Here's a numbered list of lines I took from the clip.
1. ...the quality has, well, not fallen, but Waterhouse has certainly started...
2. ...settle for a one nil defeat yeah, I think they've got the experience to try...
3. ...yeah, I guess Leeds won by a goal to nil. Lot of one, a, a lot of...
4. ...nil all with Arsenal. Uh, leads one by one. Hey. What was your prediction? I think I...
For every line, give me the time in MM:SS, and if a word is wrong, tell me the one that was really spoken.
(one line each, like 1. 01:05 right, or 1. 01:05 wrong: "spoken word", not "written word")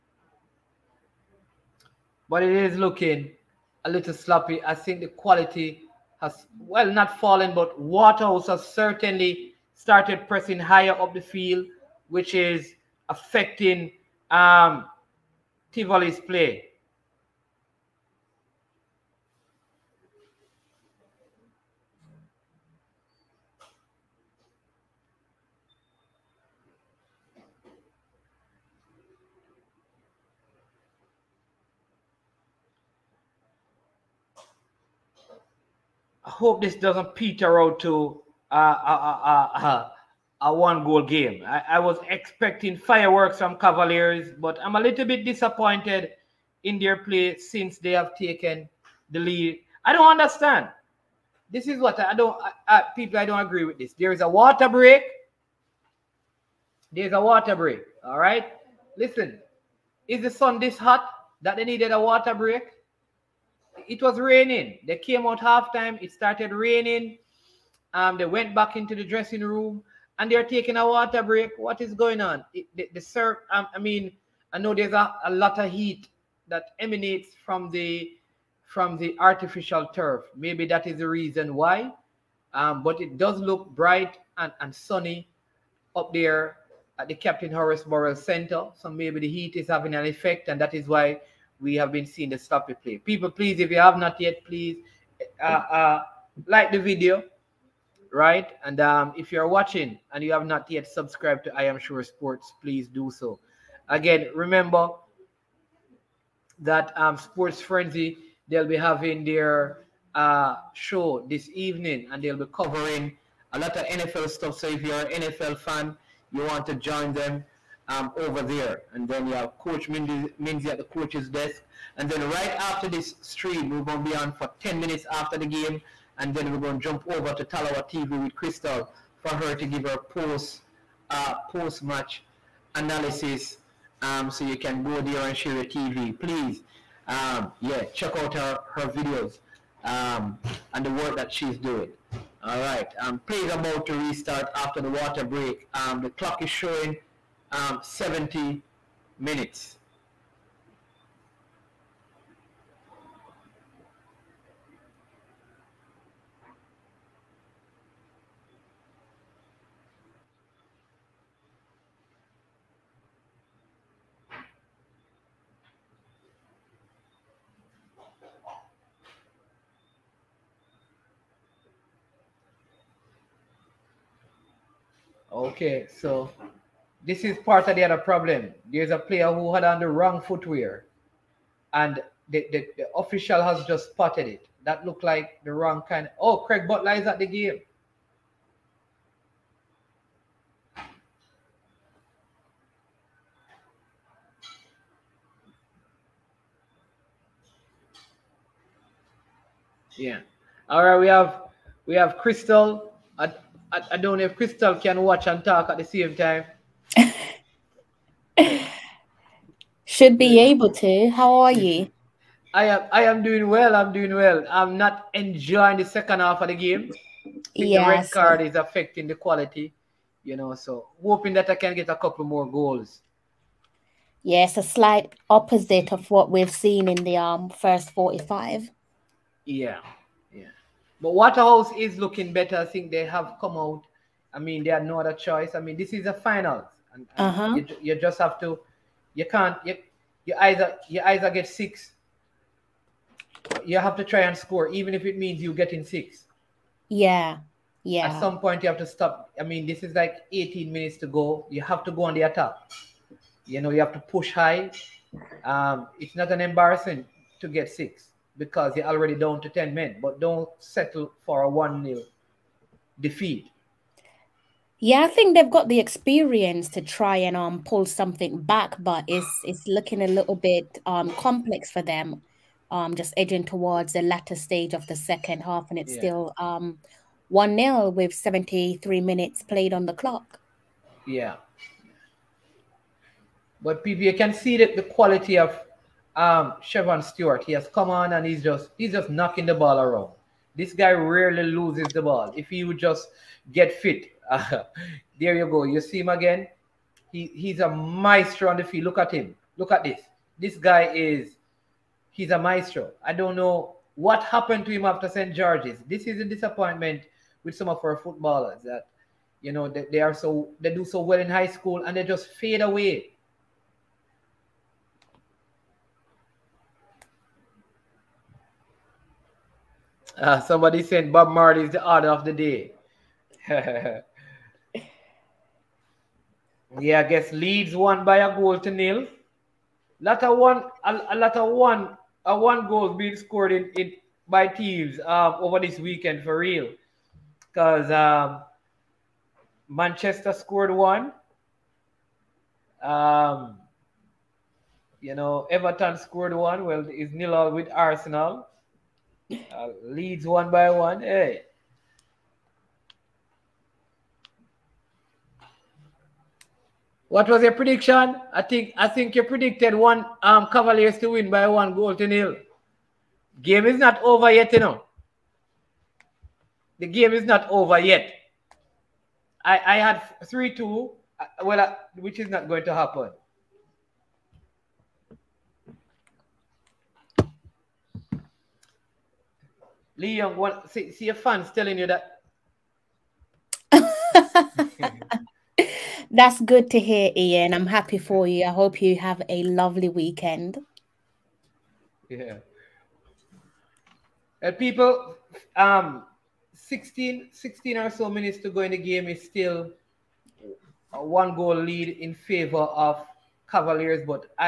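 1. 00:05 right
2. 04:20 right
3. 05:26 right
4. 05:47 right.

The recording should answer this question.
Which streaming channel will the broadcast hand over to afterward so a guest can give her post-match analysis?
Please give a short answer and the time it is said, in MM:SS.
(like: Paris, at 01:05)
Talawa TV, at 02:07.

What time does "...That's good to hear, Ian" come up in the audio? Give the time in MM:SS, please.
06:26.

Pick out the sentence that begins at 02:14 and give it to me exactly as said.
Um, so you can go there and share your TV.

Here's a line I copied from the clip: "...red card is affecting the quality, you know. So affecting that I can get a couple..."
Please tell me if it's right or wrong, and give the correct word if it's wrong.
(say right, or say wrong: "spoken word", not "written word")
wrong: "hoping", not "affecting".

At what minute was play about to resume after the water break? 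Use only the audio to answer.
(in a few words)
70 minutes.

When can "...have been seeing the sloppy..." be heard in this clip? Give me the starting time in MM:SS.
01:31.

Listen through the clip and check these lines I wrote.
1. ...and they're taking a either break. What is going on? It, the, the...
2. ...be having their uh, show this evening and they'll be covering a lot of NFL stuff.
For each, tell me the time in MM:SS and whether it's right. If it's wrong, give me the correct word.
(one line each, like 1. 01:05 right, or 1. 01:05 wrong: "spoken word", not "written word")
1. 01:10 wrong: "water", not "either"
2. 01:48 right.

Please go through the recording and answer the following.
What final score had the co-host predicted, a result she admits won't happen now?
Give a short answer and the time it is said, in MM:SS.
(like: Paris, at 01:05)
3-2, at 06:10.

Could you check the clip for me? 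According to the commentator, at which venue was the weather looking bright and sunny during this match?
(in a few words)
Captain Horace Burrell Center.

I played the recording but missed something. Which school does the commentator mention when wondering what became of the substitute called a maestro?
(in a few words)
St. George's.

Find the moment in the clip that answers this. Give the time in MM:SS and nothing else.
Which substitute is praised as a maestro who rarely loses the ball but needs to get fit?
04:46.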